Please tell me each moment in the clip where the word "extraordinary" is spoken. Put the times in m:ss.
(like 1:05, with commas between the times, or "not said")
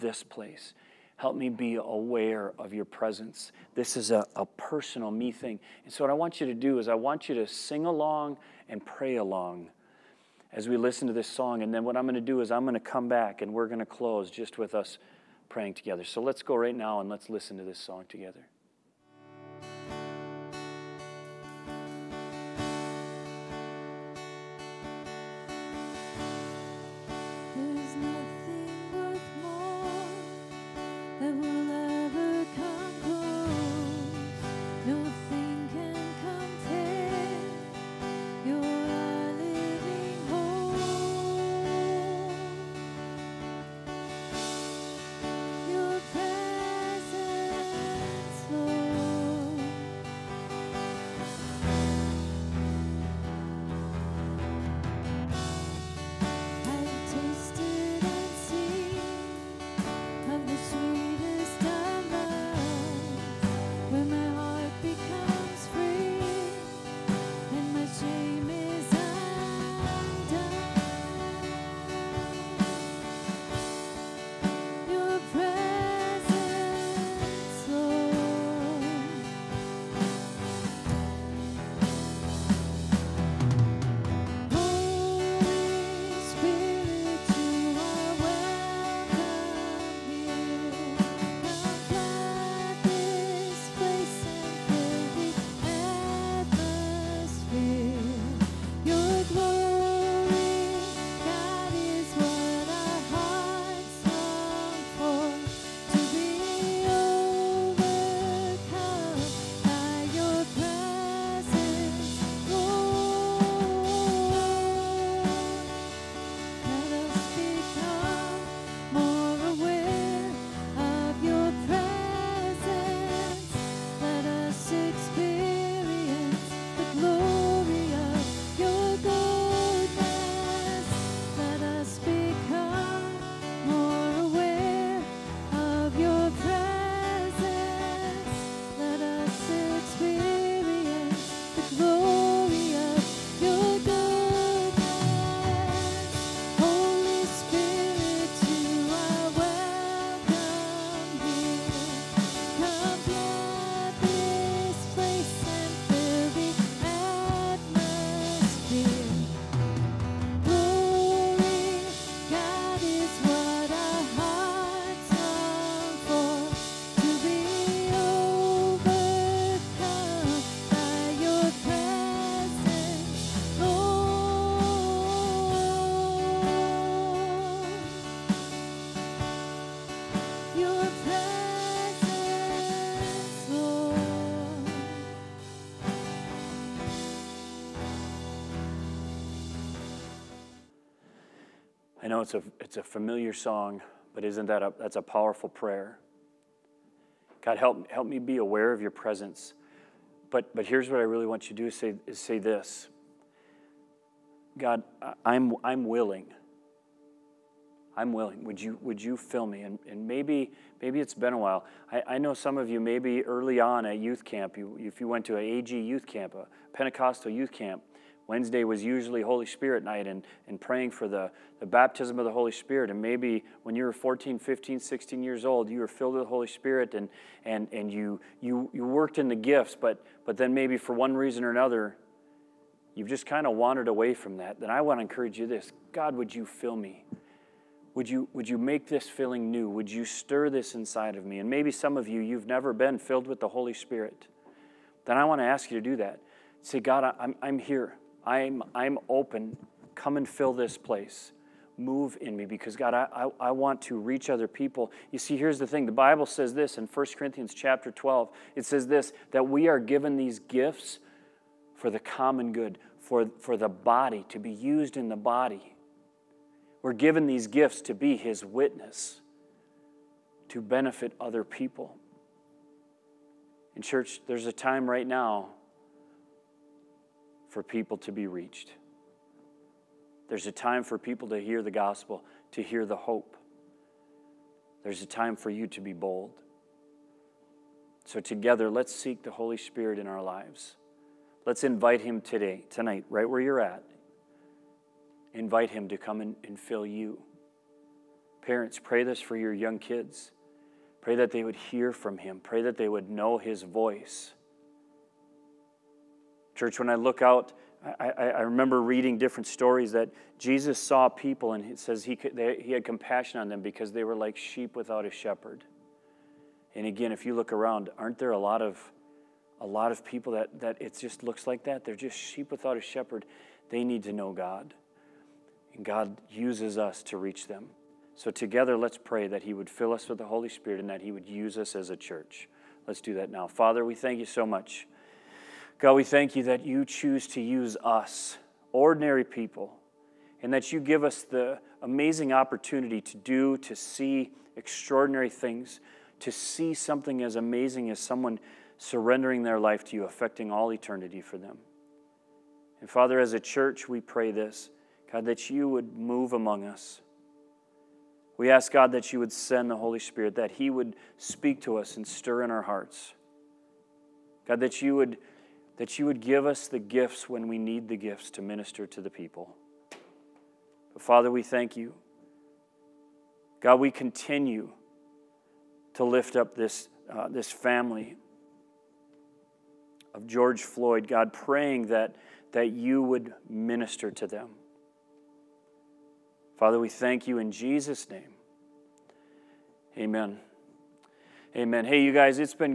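5:44.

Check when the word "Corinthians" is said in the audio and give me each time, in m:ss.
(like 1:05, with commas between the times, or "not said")
4:17.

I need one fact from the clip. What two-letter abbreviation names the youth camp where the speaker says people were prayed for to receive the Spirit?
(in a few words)
AG.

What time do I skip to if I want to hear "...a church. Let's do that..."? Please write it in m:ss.
5:31.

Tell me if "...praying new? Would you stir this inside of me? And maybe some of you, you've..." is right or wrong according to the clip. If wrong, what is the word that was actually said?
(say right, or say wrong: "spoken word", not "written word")
wrong: "feeling", not "praying".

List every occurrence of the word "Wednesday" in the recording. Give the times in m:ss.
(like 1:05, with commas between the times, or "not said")
3:38.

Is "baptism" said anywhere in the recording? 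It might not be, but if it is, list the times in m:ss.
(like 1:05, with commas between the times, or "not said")
3:41.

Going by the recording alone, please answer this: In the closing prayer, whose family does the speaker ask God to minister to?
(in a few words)
George Floyd.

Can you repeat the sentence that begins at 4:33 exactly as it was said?
In church, there's a time right now for people to be reached.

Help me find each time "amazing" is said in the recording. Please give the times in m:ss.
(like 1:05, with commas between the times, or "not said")
5:41, 5:47.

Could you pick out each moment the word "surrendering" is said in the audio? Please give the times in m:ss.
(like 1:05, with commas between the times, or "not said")
5:48.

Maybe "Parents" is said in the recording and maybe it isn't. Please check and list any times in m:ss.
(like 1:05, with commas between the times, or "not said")
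4:58.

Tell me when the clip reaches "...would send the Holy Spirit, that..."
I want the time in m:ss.
5:59.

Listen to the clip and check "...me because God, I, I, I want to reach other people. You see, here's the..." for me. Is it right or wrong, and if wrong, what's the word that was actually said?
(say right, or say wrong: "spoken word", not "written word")
right.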